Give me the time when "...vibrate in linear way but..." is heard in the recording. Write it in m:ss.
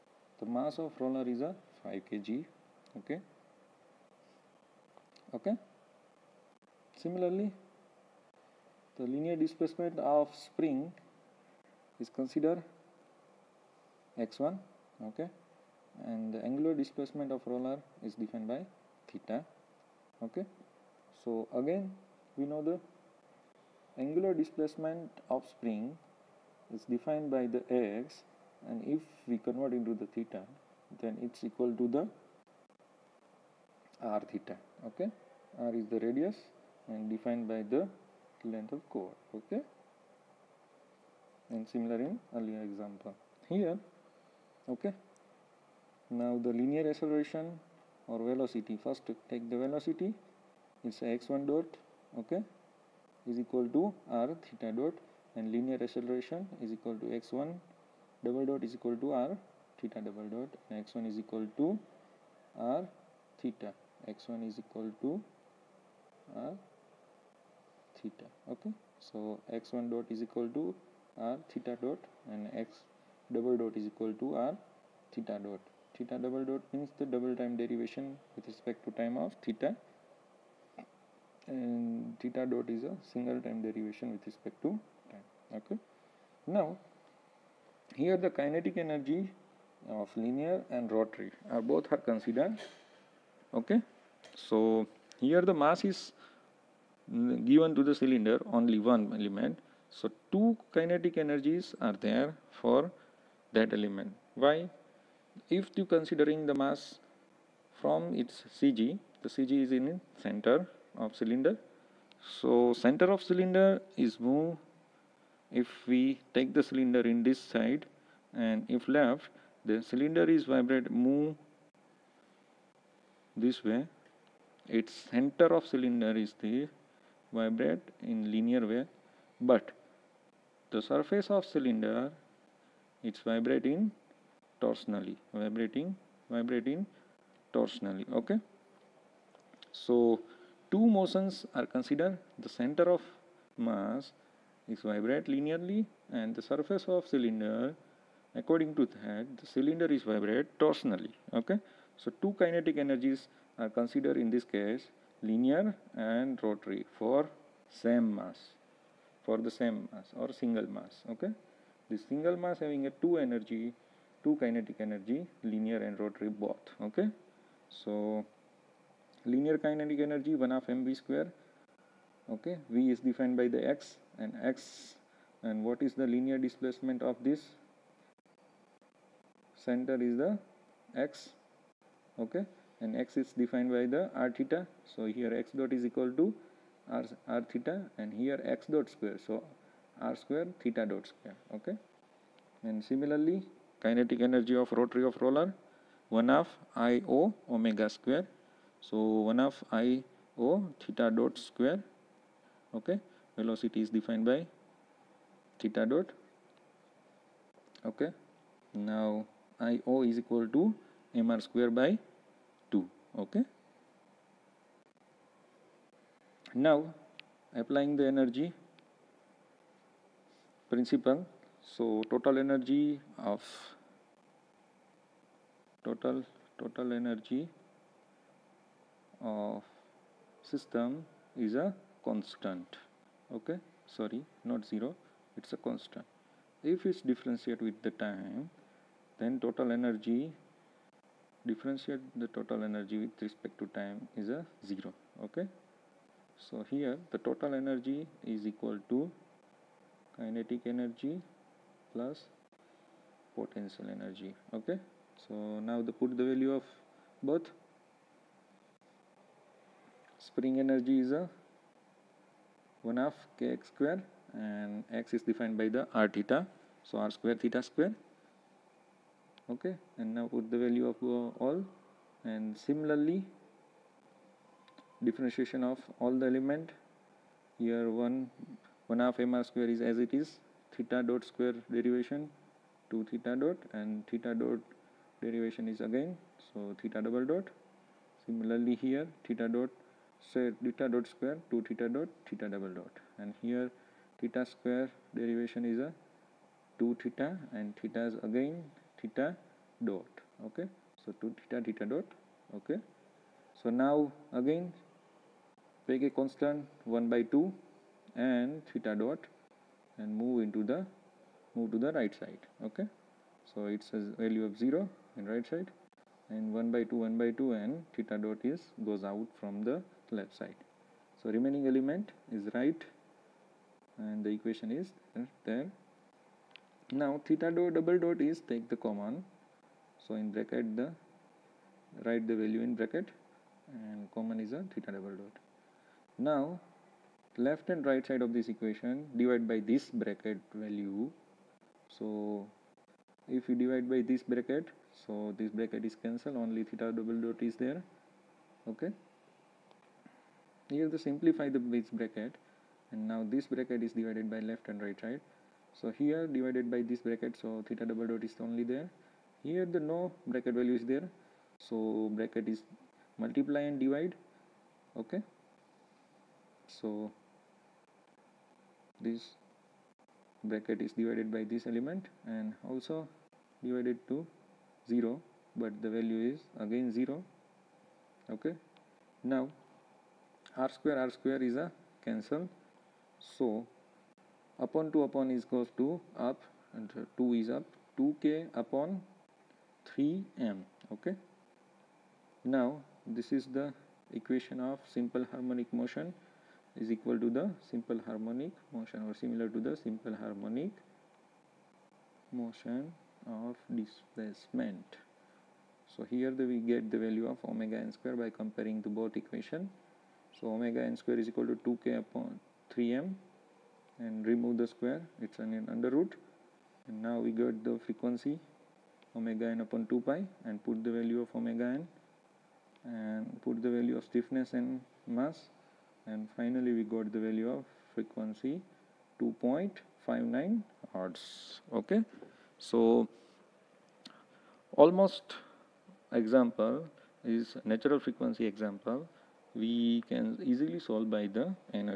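2:07.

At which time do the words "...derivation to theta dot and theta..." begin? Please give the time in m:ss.
4:41.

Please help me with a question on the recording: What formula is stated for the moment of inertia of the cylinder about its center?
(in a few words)
mr²/2.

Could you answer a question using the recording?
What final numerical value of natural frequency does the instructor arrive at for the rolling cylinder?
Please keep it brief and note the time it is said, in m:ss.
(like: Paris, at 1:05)
2.59 Hz, at 7:09.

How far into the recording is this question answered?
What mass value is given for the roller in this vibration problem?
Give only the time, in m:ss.
0:01.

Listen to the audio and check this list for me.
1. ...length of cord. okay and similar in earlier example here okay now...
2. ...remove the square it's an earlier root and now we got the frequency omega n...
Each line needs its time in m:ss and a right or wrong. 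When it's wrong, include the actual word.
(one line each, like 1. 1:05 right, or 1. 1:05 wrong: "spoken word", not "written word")
1. 0:38 right
2. 6:54 wrong: "under", not "earlier".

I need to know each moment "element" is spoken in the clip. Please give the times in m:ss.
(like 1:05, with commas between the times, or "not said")
1:39, 1:43, 4:36, 5:21, 6:11.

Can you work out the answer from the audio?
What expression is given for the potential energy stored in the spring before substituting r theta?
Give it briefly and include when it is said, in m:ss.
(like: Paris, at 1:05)
1/2 kx², at 4:22.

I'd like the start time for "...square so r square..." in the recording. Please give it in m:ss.
3:08.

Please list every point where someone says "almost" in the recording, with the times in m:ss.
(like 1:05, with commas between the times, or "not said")
7:14.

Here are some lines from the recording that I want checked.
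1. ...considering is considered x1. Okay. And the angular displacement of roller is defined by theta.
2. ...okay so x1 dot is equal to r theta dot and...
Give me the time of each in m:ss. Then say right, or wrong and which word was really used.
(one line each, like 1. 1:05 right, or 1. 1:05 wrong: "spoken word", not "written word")
1. 0:10 wrong: "spring", not "considering"
2. 1:08 right.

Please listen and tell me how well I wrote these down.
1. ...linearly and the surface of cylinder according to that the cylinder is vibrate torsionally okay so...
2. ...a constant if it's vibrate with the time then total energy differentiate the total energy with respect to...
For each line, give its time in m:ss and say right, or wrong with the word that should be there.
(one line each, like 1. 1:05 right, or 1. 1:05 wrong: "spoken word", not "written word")
1. 2:25 right
2. 3:55 wrong: "differentiate", not "vibrate".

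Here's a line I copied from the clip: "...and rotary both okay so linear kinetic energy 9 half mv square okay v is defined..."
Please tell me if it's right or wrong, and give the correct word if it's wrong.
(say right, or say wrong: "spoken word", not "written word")
wrong: "1", not "9".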